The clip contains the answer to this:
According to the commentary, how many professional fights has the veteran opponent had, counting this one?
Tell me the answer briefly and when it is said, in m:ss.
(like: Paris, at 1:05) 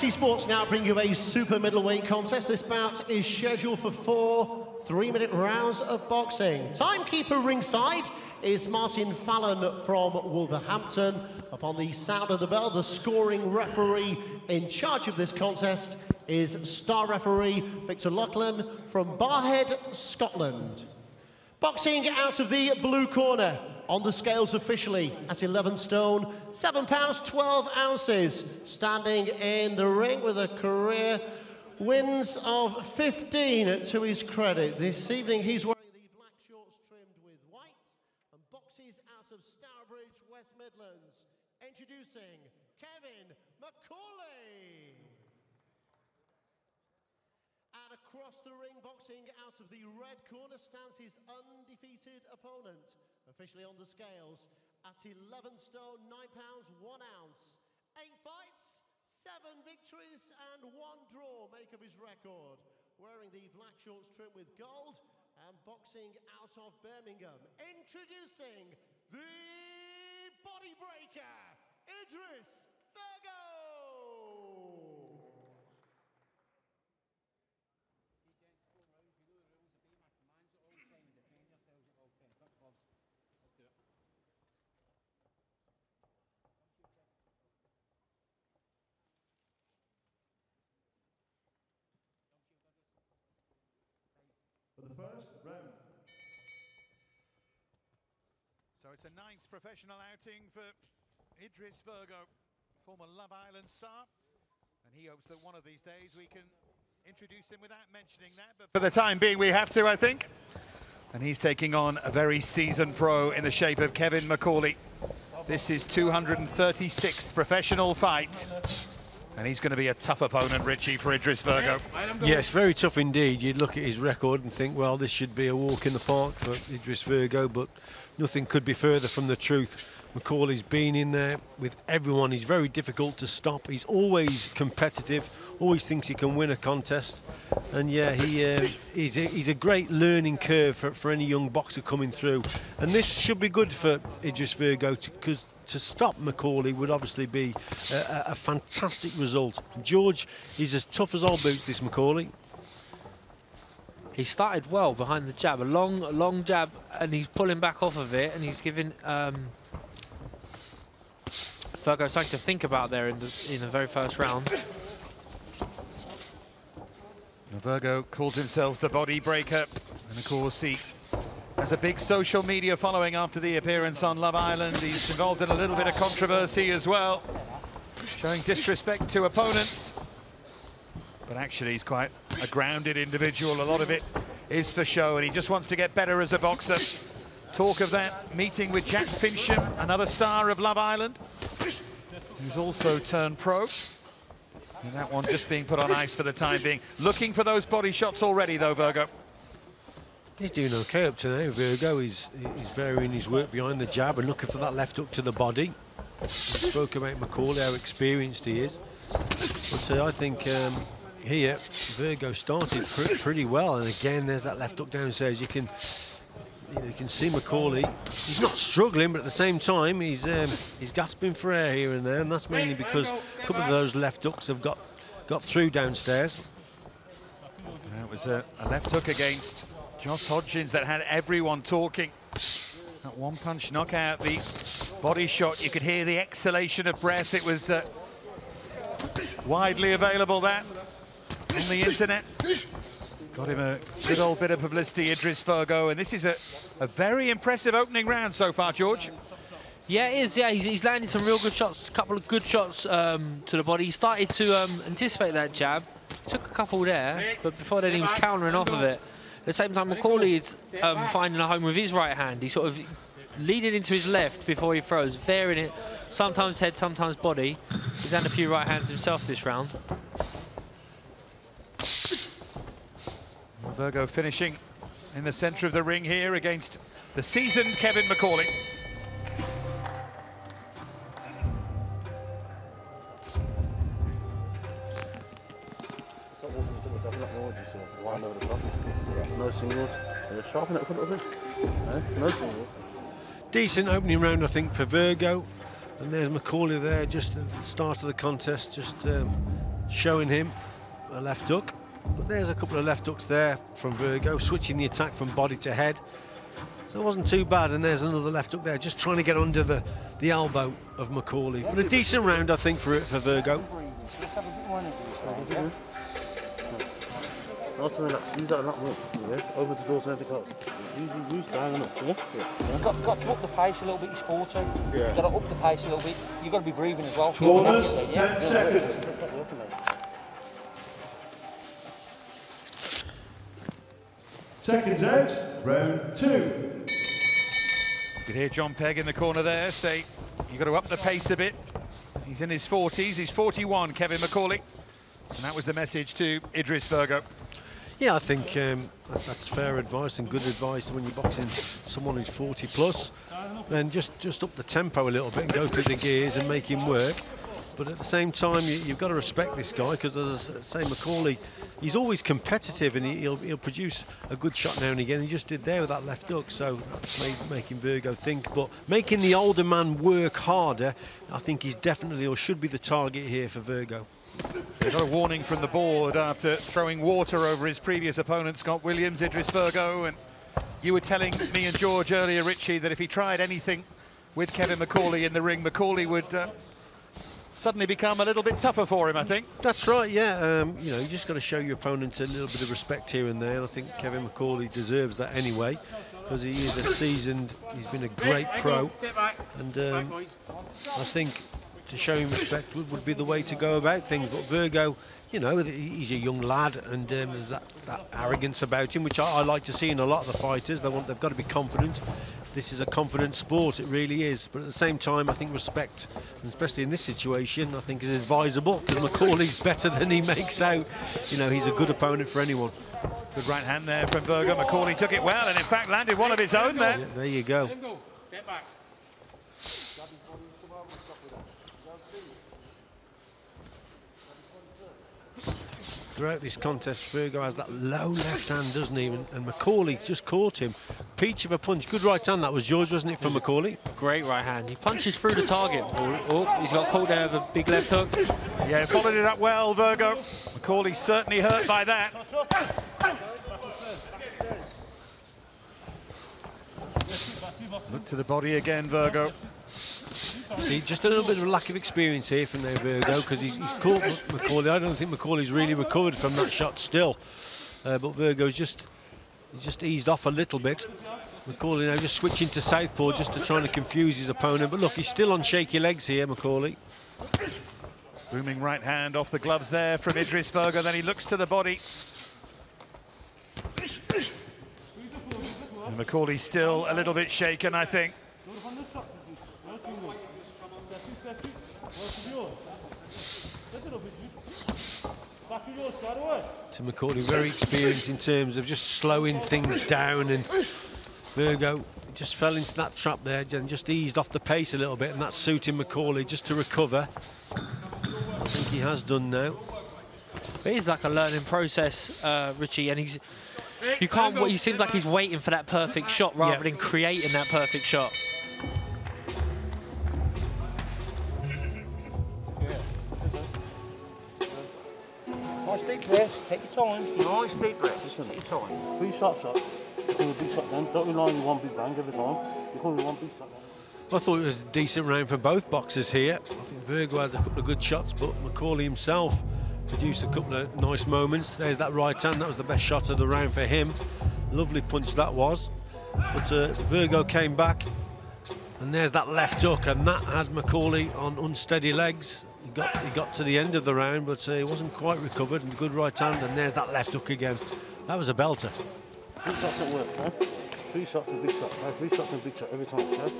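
236th, at 1:55.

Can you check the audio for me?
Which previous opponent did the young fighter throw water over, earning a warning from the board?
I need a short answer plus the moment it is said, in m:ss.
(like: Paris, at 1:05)
Scott Williams, at 6:18.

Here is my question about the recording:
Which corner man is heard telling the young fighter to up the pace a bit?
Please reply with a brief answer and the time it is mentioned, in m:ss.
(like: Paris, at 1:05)
John Pegg, at 5:38.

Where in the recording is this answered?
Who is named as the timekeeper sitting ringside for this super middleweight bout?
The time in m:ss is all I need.
0:08.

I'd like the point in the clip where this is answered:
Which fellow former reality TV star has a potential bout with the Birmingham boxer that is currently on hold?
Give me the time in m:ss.
3:08.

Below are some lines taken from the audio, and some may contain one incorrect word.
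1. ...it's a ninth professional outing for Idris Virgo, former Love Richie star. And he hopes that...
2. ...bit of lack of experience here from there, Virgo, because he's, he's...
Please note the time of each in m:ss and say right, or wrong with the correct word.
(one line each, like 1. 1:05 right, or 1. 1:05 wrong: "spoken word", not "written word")
1. 1:38 wrong: "Island", not "Richie"
2. 7:41 right.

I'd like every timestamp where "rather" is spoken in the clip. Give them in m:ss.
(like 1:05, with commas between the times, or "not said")
8:36.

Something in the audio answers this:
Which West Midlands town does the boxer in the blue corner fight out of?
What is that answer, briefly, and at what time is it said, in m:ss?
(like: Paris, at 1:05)
Stourbridge, at 0:39.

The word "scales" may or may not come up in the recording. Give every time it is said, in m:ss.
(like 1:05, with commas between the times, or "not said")
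0:24, 0:53.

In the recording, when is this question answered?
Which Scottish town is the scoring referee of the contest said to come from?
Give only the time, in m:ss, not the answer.
0:19.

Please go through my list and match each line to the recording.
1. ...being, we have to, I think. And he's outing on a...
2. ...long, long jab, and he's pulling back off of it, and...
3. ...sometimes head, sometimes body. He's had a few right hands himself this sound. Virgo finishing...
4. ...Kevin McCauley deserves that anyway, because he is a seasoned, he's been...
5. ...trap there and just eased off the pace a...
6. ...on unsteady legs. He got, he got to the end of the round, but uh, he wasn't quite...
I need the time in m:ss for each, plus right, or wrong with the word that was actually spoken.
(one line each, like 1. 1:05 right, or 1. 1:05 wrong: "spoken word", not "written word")
1. 1:49 wrong: "taking", not "outing"
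2. 2:35 right
3. 4:26 wrong: "round", not "sound"
4. 6:33 right
5. 8:22 right
6. 9:11 right.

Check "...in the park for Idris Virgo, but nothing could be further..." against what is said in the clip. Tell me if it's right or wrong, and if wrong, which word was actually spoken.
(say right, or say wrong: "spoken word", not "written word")
right.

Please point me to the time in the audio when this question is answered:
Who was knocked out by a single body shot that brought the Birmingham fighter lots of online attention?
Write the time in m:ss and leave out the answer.
3:49.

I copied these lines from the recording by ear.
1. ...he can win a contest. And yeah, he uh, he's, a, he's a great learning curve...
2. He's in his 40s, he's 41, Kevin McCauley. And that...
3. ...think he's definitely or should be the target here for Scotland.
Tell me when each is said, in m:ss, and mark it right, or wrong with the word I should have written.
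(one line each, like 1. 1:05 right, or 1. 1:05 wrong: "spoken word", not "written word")
1. 2:16 right
2. 5:42 right
3. 6:11 wrong: "Virgo", not "Scotland".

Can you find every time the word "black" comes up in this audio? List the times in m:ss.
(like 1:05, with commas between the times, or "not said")
0:36, 1:03.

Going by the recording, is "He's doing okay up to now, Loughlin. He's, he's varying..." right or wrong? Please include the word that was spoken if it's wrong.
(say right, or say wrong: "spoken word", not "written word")
wrong: "Virgo", not "Loughlin".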